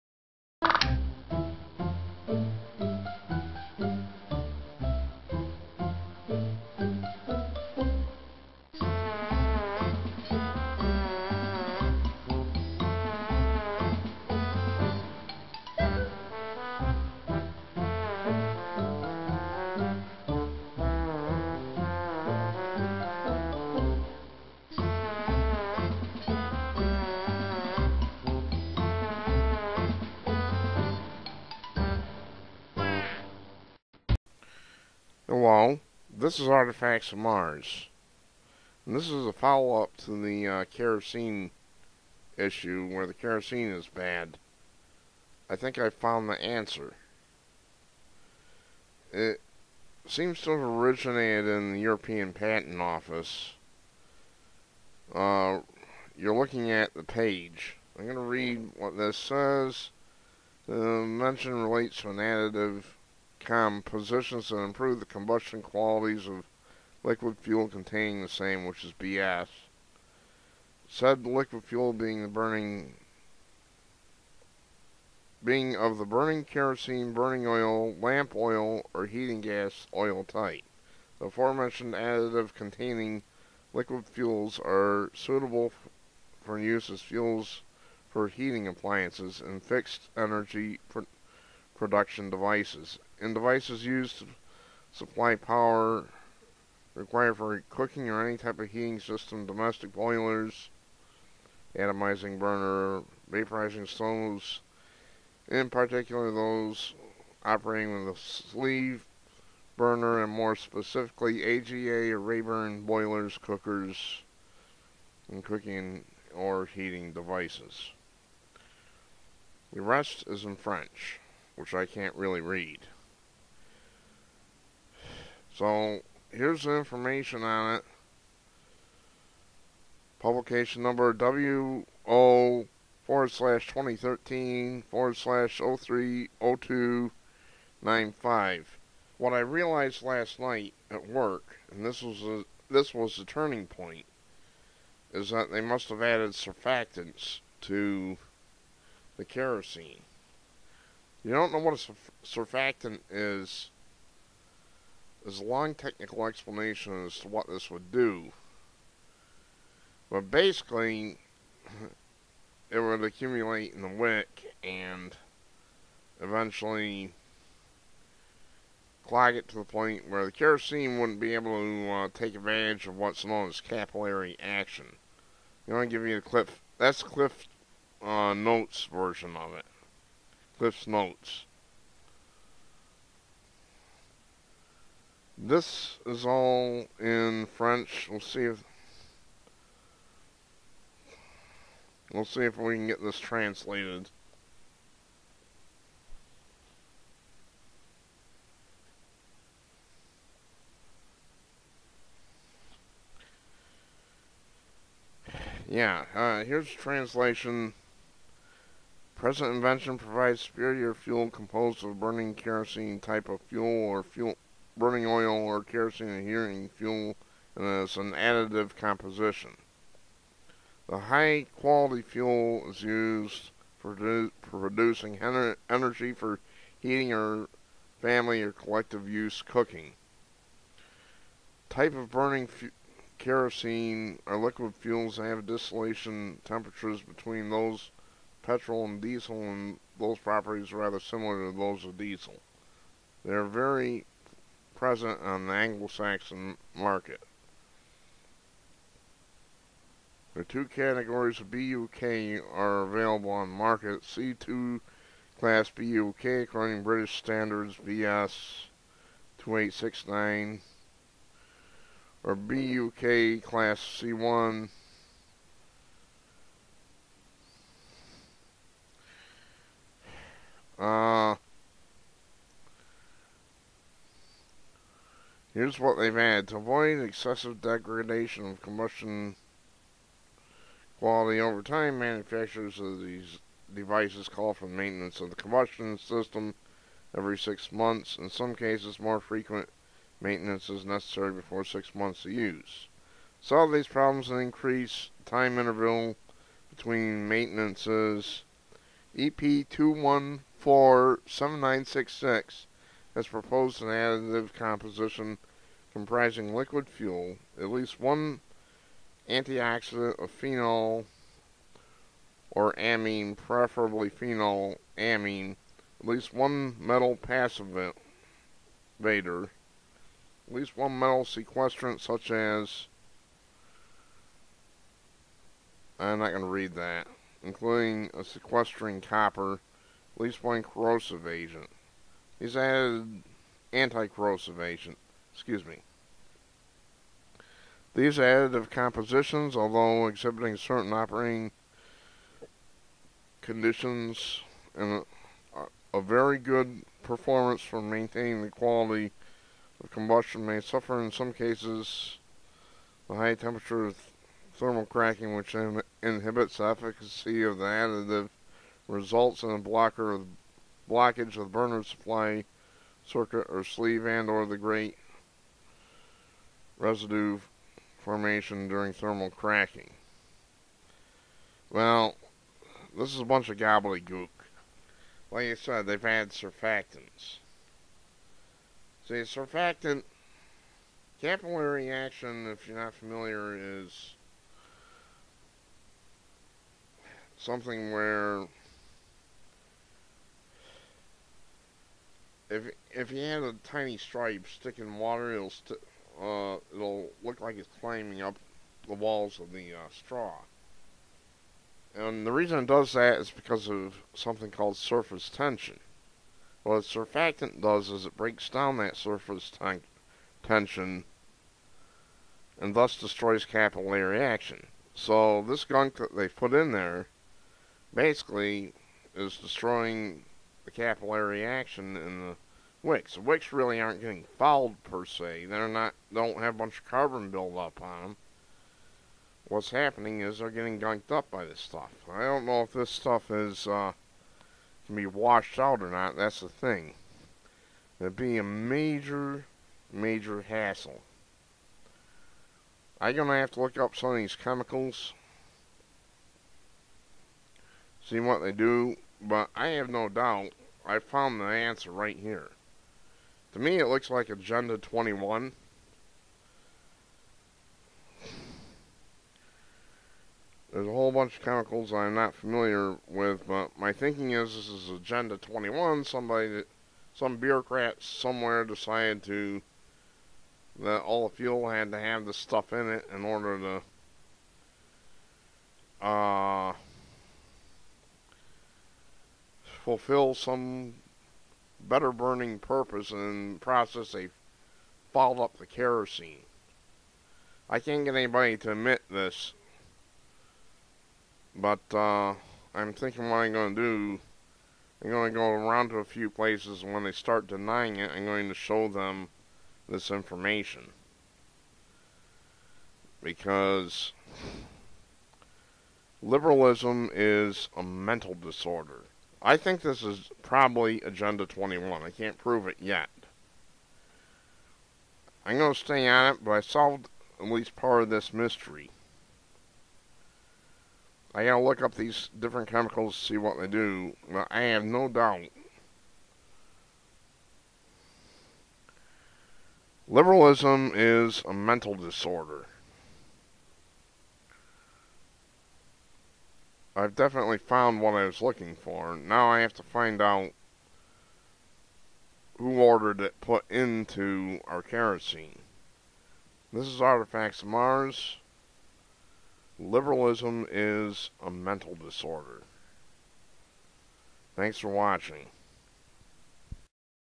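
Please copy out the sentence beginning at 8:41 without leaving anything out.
I gotta look up these different chemicals to see what they do, but I have no doubt.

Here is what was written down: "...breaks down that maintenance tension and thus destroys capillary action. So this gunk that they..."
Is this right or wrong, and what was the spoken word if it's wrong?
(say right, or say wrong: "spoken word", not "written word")
wrong: "surface", not "maintenance".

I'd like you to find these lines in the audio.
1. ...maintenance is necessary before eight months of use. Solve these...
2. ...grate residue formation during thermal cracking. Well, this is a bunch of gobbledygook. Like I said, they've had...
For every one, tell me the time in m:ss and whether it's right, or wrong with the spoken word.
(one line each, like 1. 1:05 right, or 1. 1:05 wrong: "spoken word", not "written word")
1. 4:50 wrong: "six", not "eight"
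2. 6:04 right.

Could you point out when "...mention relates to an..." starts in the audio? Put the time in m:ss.
1:00.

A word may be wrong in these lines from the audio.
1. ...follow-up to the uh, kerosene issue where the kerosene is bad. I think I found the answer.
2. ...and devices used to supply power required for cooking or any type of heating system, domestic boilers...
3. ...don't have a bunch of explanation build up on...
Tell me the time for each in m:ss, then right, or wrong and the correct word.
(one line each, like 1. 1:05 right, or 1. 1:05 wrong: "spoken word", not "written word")
1. 0:39 right
2. 1:33 right
3. 7:06 wrong: "carbon", not "explanation".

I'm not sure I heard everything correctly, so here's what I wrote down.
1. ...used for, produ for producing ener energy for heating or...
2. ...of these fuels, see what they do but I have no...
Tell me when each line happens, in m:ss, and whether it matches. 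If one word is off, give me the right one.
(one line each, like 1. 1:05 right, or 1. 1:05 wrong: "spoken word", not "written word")
1. 3:42 right
2. 7:24 wrong: "chemicals", not "fuels".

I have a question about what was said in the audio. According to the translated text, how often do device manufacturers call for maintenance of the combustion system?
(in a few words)
Every six months.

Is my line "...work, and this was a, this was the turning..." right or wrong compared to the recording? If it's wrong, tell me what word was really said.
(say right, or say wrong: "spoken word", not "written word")
right.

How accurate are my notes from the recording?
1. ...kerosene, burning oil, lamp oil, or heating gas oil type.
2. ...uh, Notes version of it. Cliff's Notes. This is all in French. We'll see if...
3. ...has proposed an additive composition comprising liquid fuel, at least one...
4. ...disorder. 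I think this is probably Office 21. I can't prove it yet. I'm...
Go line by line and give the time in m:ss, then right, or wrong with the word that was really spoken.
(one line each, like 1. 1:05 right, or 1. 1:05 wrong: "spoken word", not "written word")
1. 1:16 right
2. 2:58 right
3. 5:03 right
4. 8:28 wrong: "Agenda", not "Office".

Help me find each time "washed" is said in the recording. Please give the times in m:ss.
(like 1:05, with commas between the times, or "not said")
7:15.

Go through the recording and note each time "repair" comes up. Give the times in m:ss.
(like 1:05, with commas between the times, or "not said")
not said.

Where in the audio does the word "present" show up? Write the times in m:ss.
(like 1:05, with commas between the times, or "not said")
3:29, 4:04.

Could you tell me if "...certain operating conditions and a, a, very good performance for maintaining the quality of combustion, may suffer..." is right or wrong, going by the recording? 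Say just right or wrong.
right.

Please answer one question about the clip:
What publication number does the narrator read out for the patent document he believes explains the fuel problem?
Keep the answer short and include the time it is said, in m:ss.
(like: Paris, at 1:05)
WO/2013/030295, at 2:11.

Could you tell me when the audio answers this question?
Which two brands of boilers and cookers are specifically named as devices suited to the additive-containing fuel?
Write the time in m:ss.
1:51.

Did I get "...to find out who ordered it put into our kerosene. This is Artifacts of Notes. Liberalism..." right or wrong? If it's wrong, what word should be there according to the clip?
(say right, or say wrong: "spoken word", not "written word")
wrong: "Mars", not "Notes".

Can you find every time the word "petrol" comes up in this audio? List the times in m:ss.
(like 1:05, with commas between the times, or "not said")
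3:58.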